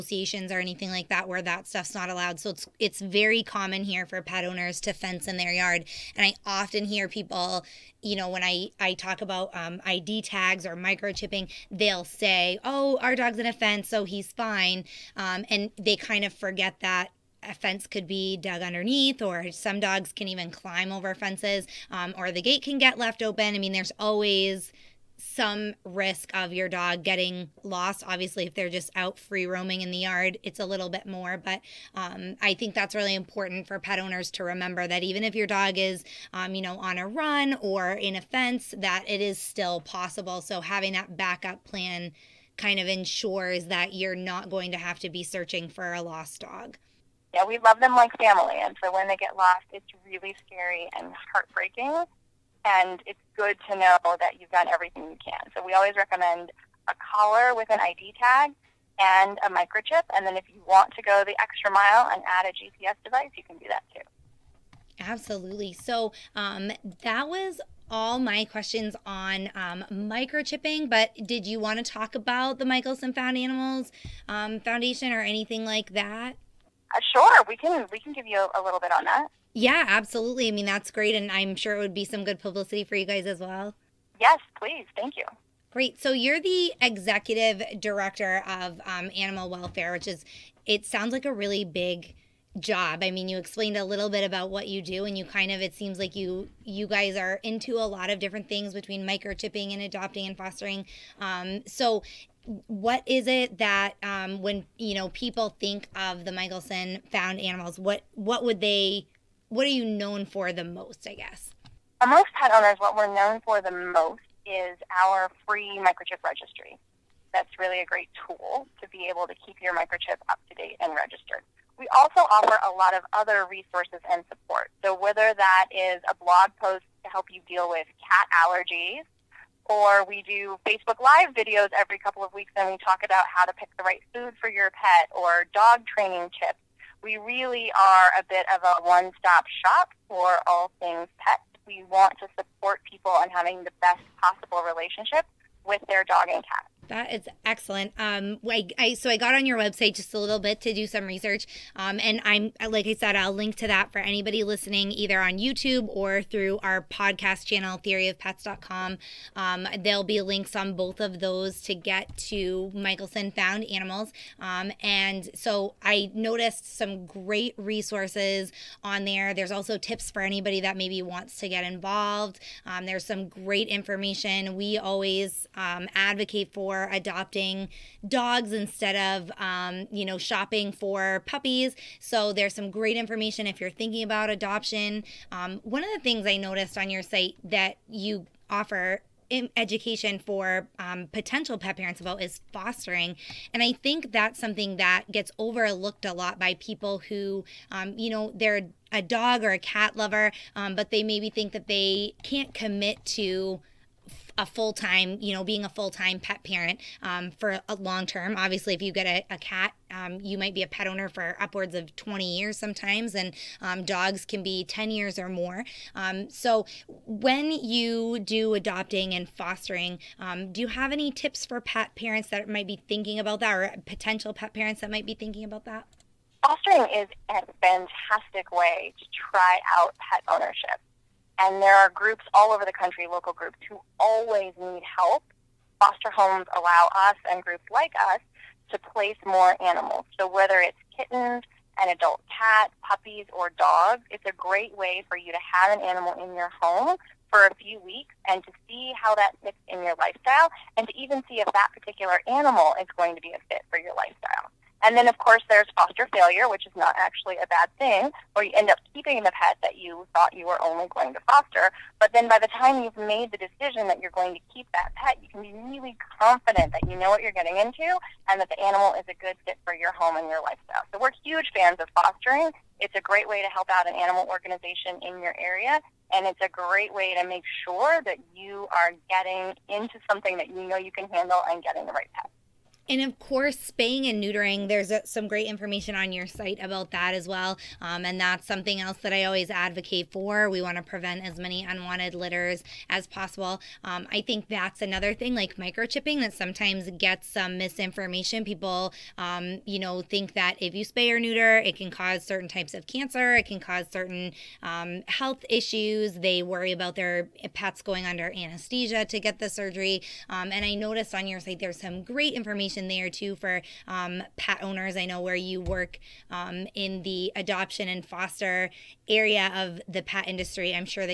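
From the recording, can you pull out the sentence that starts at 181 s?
So there's some great information if you're thinking about adoption.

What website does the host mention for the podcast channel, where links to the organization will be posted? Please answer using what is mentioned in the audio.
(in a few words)
theoryofpets.com.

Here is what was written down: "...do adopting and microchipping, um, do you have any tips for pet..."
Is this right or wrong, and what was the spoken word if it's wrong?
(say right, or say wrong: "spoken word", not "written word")
wrong: "fostering", not "microchipping".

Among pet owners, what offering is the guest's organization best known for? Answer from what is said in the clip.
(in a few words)
free microchip registry.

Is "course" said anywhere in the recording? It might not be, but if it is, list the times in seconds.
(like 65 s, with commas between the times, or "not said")
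255 s, 283 s.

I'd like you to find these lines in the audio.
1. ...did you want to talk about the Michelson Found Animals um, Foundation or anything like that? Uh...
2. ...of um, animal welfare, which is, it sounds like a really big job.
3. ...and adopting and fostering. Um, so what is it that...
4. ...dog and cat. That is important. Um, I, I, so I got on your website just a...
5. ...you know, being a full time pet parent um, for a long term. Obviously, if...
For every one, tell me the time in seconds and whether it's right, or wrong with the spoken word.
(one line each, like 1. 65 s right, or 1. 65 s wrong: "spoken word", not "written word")
1. 71 s right
2. 88 s right
3. 99 s right
4. 146 s wrong: "excellent", not "important"
5. 205 s right.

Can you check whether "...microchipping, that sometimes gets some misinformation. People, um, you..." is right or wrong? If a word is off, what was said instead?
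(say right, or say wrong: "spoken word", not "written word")
right.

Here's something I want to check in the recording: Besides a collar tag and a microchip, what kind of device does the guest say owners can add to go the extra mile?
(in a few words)
GPS device.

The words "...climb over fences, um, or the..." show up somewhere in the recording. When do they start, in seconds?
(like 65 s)
20 s.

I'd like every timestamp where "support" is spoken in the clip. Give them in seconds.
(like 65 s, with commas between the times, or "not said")
124 s, 142 s.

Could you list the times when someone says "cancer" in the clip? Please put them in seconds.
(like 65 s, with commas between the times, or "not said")
302 s.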